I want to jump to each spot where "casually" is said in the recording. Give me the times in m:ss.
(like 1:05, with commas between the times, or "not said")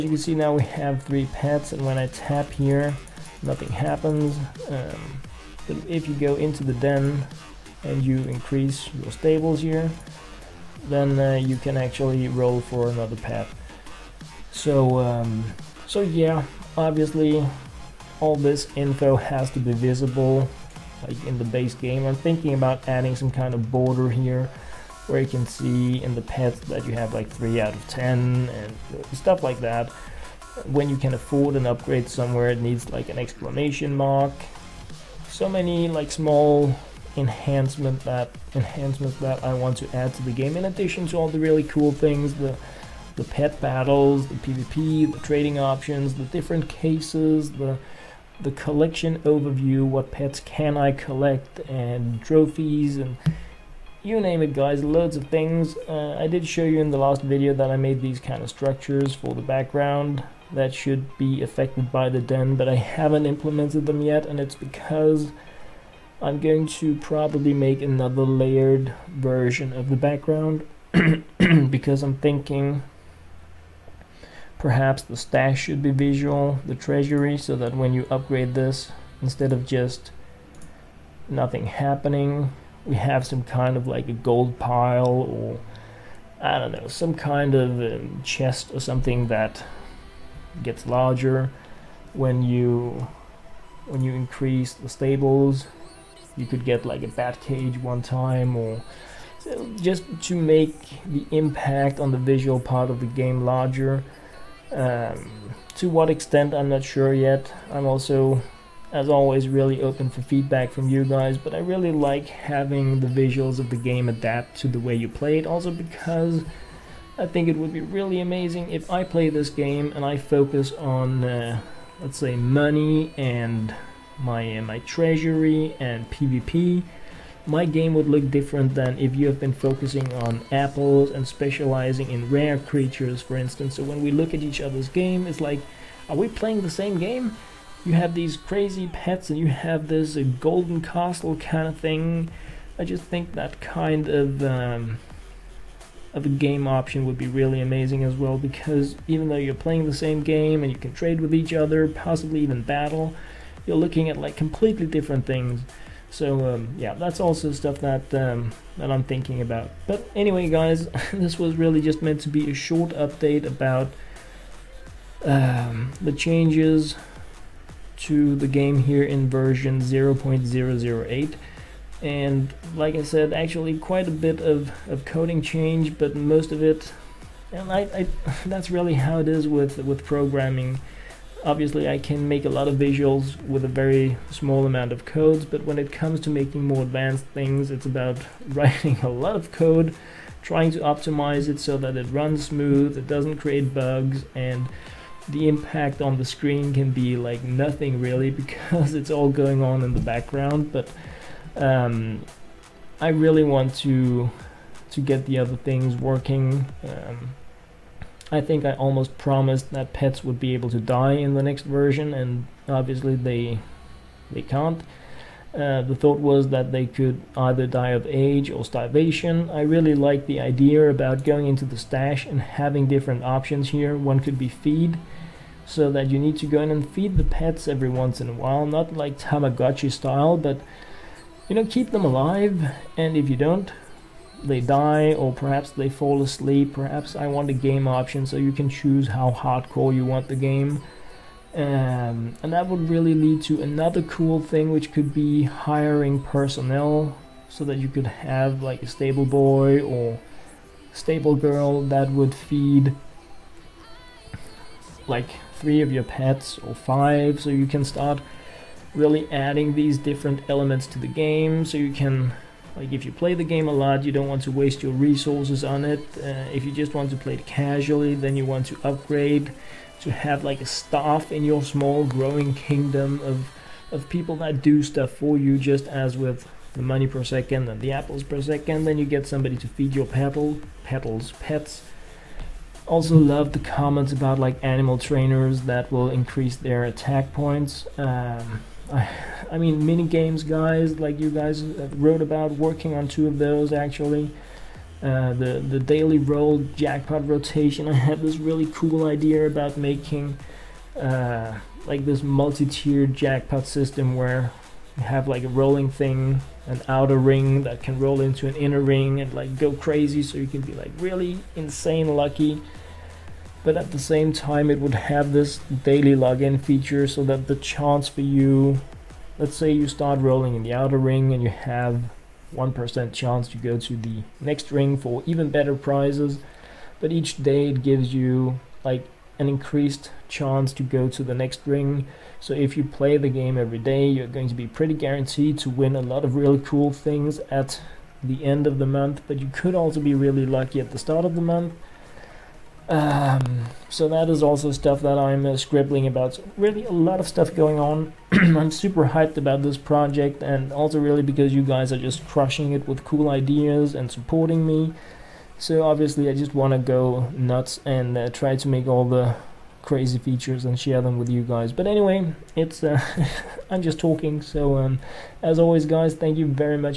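4:27.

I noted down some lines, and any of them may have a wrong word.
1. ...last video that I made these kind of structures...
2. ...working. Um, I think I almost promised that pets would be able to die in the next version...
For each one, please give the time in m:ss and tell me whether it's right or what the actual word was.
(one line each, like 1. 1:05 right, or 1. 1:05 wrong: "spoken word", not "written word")
1. 0:56 right
2. 3:25 right.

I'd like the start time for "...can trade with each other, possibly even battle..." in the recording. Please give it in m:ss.
2:30.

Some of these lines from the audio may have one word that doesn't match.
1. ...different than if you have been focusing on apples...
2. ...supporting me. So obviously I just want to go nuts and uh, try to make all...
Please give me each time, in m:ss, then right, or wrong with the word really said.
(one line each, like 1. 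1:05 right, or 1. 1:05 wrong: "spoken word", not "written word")
1. 2:08 right
2. 5:54 right.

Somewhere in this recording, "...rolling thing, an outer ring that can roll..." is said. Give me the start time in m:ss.
5:05.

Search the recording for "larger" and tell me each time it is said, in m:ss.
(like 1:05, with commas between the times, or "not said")
1:30, 1:43.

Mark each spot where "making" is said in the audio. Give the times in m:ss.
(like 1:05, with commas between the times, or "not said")
3:06, 4:59.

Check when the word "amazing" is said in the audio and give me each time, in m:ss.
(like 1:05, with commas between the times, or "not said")
1:58, 2:27.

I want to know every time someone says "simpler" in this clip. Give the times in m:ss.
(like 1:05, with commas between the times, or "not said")
not said.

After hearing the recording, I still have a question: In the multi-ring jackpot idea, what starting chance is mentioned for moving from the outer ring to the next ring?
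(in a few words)
1%.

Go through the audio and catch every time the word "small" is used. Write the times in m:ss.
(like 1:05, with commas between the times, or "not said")
0:36, 3:04, 4:31.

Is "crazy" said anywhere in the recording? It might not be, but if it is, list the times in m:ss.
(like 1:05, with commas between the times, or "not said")
2:18, 5:09, 5:59.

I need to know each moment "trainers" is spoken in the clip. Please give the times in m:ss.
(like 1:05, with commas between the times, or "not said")
4:44.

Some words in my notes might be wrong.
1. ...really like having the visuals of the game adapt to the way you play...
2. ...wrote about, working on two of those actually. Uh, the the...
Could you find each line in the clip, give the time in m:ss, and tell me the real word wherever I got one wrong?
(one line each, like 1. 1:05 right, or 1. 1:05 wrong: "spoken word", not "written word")
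1. 1:51 right
2. 4:51 right.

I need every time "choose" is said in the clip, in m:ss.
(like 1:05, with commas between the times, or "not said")
3:58.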